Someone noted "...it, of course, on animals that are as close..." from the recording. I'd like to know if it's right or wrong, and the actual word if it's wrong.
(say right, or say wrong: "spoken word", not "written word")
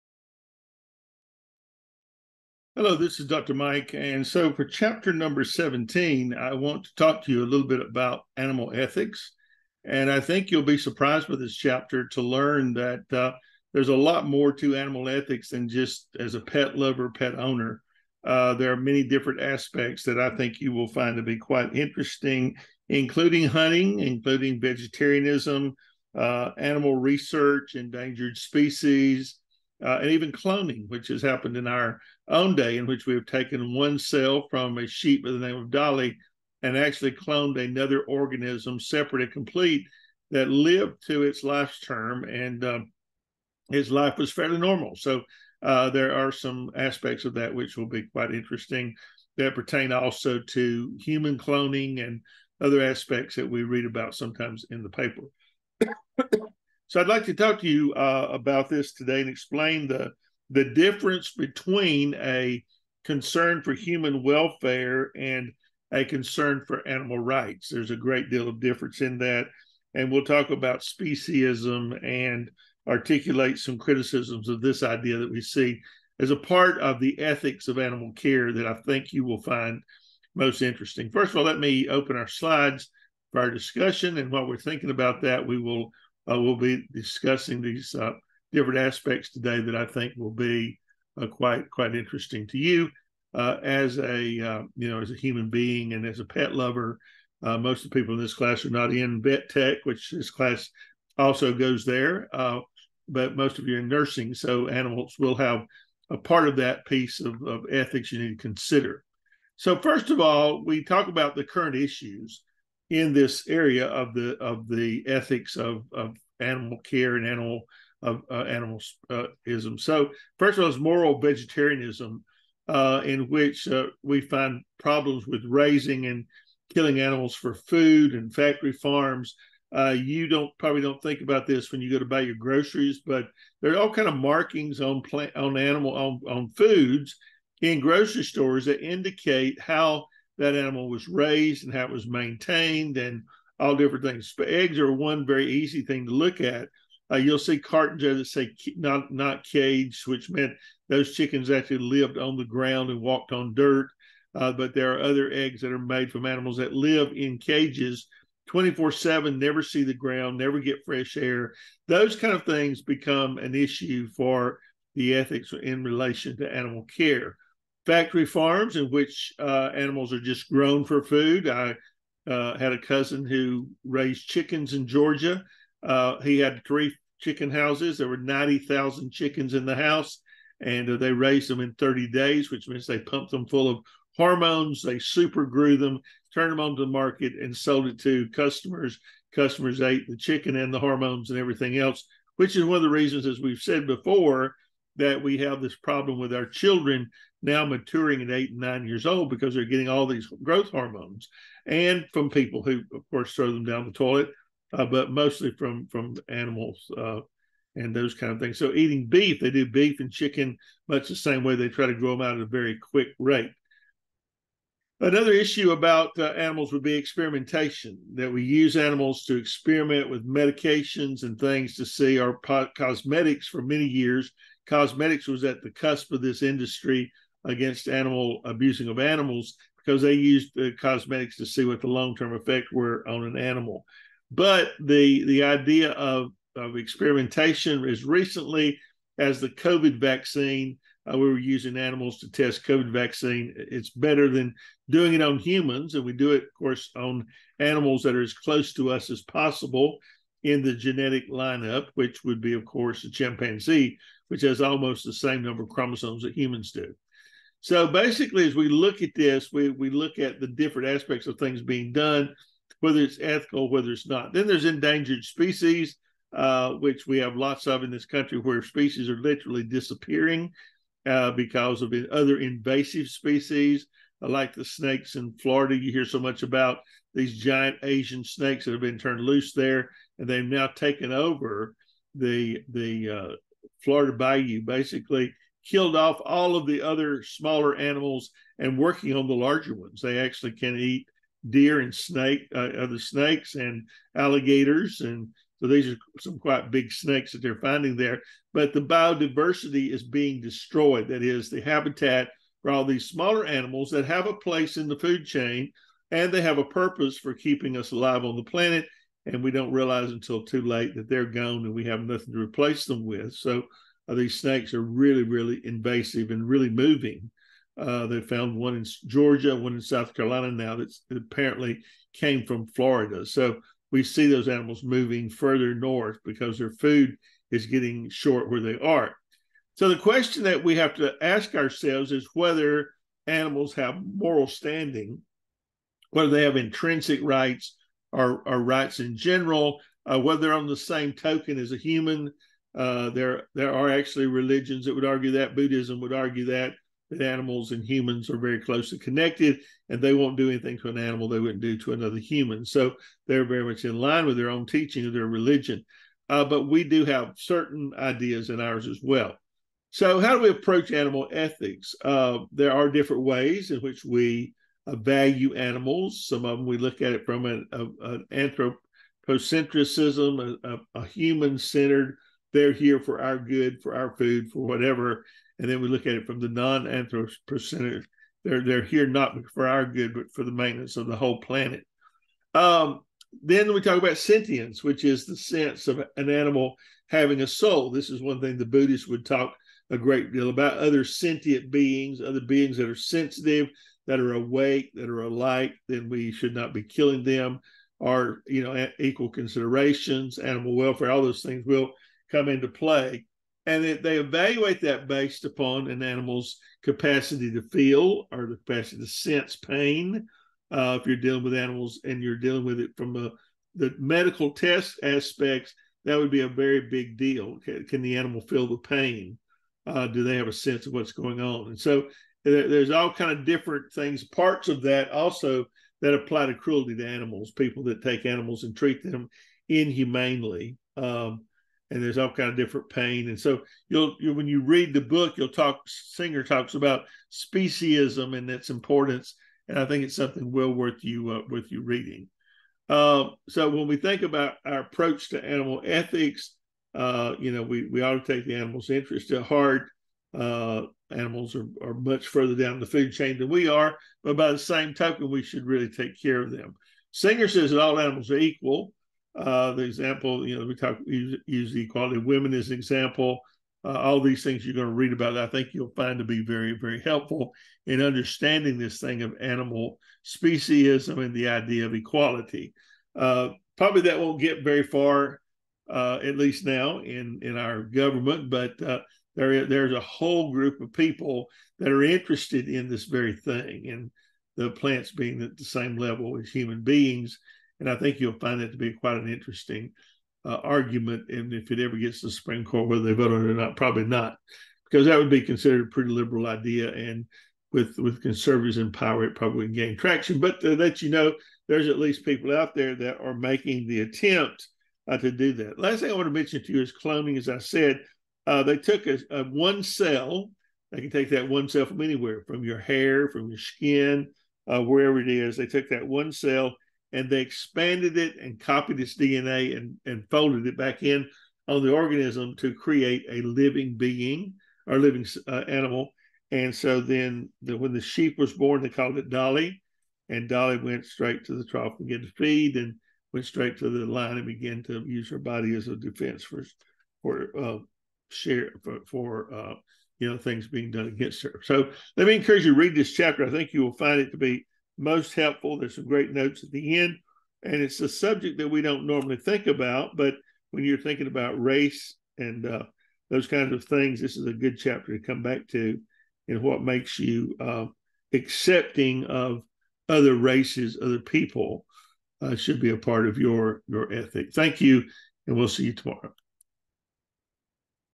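right.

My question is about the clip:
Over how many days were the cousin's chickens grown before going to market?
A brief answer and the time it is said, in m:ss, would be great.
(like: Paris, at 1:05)
30 days, at 3:01.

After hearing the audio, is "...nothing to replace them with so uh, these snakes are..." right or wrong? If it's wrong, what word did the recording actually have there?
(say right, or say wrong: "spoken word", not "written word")
right.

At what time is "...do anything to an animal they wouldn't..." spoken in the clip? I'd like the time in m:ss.
5:50.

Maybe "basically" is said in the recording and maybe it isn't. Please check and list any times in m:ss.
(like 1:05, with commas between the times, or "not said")
4:17, 4:44.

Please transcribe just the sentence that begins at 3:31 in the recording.
They try to grow them out at a very quick rate.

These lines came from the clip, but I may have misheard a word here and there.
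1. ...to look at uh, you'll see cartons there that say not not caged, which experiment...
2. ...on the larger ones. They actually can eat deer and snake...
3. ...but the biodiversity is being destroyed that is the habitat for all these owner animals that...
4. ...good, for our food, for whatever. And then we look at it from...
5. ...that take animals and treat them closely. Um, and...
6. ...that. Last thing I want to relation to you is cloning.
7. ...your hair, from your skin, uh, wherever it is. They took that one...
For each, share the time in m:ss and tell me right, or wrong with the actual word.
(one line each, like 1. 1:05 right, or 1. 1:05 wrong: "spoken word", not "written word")
1. 2:26 wrong: "meant", not "experiment"
2. 4:49 right
3. 4:58 wrong: "smaller", not "owner"
4. 6:13 right
5. 7:07 wrong: "inhumanely", not "closely"
6. 8:25 wrong: "mention", not "relation"
7. 8:32 right.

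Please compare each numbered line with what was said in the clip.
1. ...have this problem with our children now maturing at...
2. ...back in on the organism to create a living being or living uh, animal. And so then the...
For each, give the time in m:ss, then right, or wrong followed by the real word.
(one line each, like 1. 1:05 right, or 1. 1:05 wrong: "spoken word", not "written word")
1. 3:15 right
2. 8:40 right.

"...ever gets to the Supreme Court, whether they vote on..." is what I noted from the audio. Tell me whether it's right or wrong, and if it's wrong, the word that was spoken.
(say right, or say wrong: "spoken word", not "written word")
right.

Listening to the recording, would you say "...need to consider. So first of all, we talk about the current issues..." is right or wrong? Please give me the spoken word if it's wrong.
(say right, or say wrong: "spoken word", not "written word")
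right.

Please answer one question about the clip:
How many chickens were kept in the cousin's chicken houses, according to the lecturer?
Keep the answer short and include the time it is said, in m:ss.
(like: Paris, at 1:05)
90,000, at 2:58.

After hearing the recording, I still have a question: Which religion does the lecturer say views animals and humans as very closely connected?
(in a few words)
Buddhism.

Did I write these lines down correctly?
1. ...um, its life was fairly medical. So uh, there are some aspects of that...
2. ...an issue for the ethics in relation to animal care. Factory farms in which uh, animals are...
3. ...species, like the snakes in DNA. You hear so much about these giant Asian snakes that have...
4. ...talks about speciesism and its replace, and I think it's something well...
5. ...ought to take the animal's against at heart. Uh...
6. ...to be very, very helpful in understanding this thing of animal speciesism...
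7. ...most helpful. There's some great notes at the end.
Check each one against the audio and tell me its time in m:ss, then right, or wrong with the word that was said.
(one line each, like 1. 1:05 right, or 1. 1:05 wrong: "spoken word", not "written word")
1. 0:42 wrong: "normal", not "medical"
2. 2:43 right
3. 4:33 wrong: "Florida", not "DNA"
4. 7:16 wrong: "importance", not "replace"
5. 7:28 wrong: "interest", not "against"
6. 7:46 right
7. 9:05 right.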